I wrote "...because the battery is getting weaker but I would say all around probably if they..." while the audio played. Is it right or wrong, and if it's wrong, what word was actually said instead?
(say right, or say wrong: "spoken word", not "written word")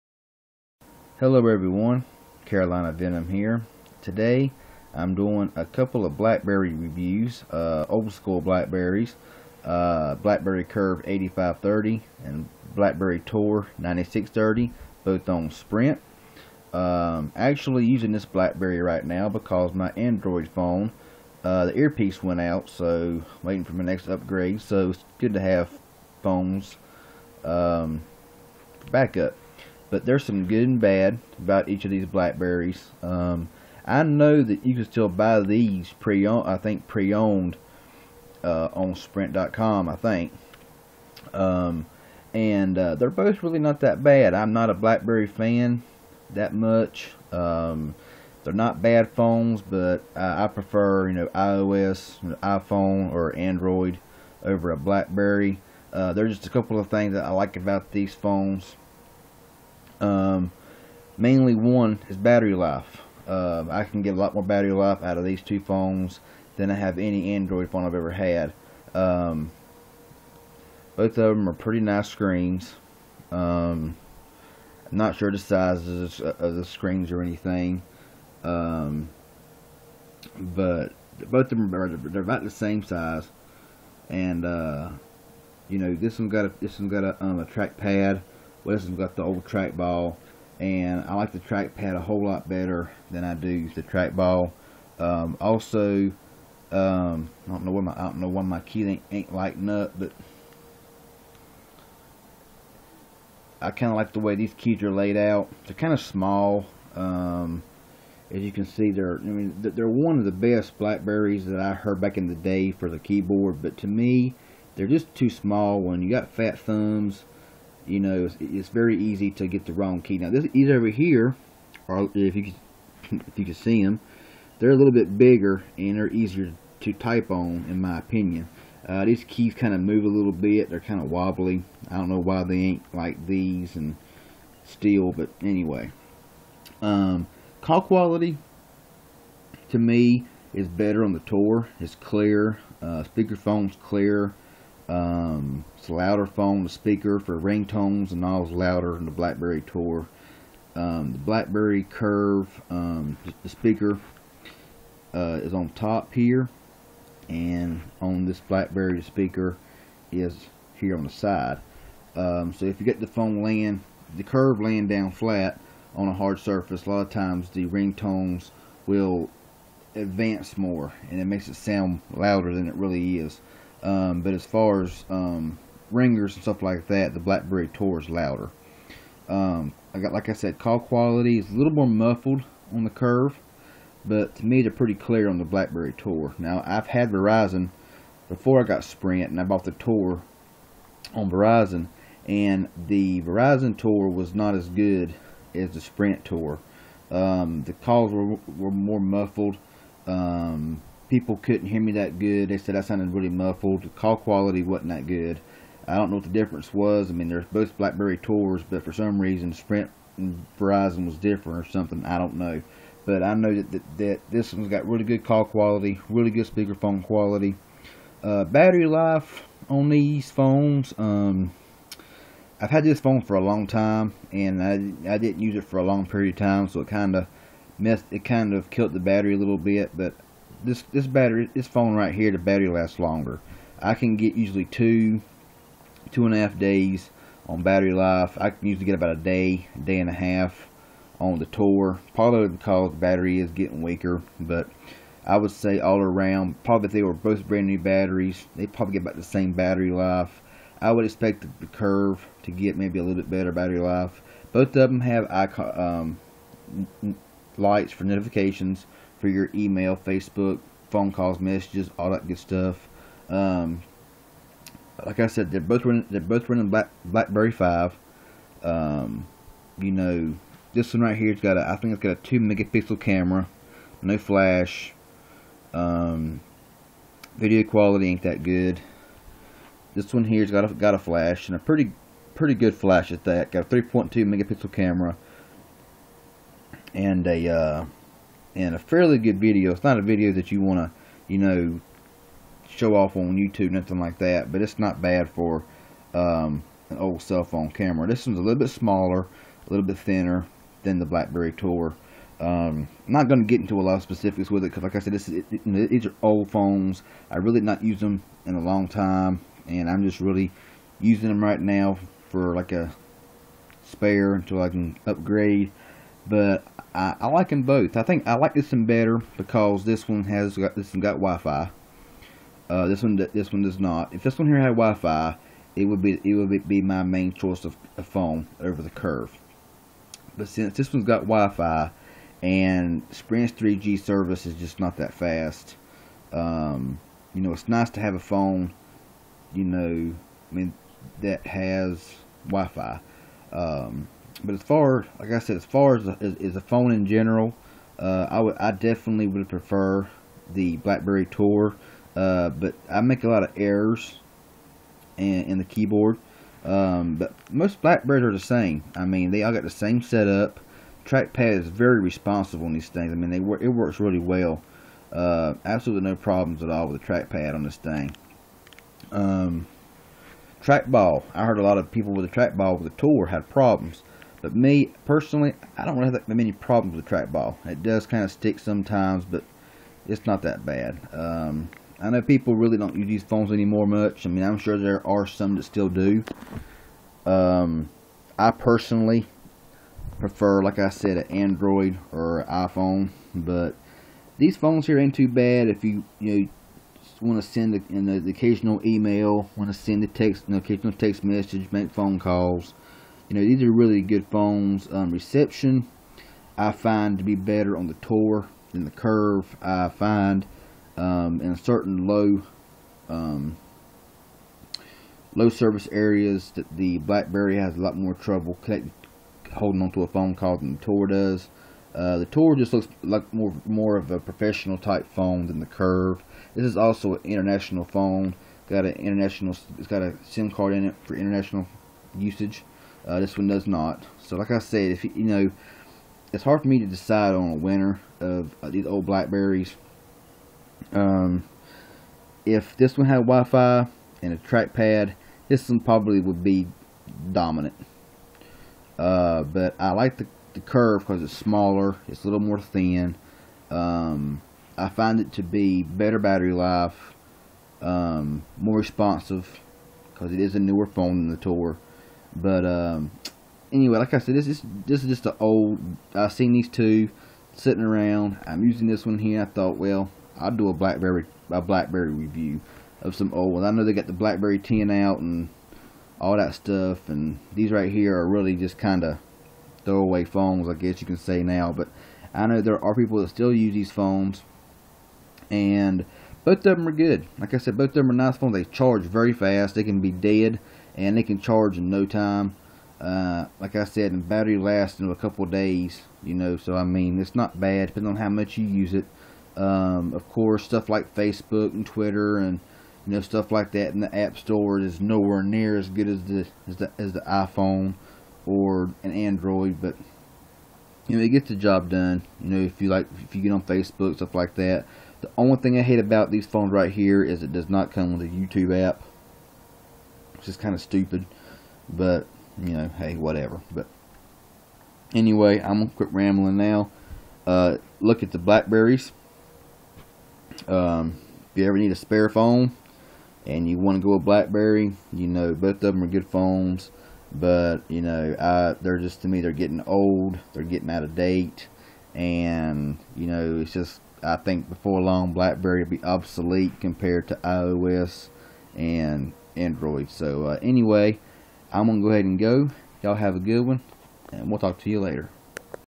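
right.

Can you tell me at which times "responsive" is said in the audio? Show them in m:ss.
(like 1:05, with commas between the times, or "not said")
6:01, 7:38.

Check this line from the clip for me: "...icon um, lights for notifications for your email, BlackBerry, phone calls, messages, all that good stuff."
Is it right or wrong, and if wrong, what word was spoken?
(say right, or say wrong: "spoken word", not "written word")
wrong: "Facebook", not "BlackBerry".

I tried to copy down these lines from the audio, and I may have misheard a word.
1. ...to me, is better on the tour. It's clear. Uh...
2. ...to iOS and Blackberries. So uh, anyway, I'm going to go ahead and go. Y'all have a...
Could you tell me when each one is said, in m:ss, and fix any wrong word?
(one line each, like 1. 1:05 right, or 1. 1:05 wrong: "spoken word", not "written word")
1. 2:19 right
2. 9:07 wrong: "Android", not "Blackberries".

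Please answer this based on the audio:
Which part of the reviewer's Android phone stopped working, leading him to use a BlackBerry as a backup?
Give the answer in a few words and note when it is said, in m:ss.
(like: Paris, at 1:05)
earpiece, at 0:21.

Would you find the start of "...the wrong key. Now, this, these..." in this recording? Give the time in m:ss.
1:59.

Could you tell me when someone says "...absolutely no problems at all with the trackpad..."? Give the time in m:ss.
6:05.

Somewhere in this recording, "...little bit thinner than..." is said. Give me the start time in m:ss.
4:59.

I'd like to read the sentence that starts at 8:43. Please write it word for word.
But anyway, I'm gonna quit rambling now.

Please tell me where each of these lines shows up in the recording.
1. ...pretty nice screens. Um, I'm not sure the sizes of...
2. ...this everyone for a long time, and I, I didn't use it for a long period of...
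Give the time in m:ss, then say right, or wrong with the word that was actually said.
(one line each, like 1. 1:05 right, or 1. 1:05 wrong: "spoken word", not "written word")
1. 1:11 right
2. 3:42 wrong: "phone", not "everyone".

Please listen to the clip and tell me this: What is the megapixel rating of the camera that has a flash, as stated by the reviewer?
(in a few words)
3.2 megapixels.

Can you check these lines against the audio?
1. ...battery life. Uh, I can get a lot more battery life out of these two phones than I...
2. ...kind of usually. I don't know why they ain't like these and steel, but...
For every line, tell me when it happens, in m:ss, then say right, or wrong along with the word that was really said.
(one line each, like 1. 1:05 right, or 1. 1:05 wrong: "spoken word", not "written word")
1. 1:02 right
2. 2:10 wrong: "wobbly", not "usually".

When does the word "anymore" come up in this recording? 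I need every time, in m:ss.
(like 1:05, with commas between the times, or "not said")
6:23.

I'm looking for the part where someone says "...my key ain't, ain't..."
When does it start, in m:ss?
1:38.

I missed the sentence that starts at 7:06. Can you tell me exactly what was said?
This is also an international phone.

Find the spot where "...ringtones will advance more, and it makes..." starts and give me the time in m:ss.
2:47.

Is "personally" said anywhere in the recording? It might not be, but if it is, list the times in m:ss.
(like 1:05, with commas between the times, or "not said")
6:15, 6:28.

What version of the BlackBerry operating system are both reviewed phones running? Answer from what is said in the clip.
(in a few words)
BlackBerry 5.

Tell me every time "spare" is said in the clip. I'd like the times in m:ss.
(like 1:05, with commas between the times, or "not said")
5:13, 8:51.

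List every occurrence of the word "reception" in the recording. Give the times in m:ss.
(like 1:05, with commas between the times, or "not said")
6:45.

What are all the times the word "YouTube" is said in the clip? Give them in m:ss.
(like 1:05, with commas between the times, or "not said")
4:53, 8:38.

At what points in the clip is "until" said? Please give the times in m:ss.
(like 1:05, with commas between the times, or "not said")
5:14.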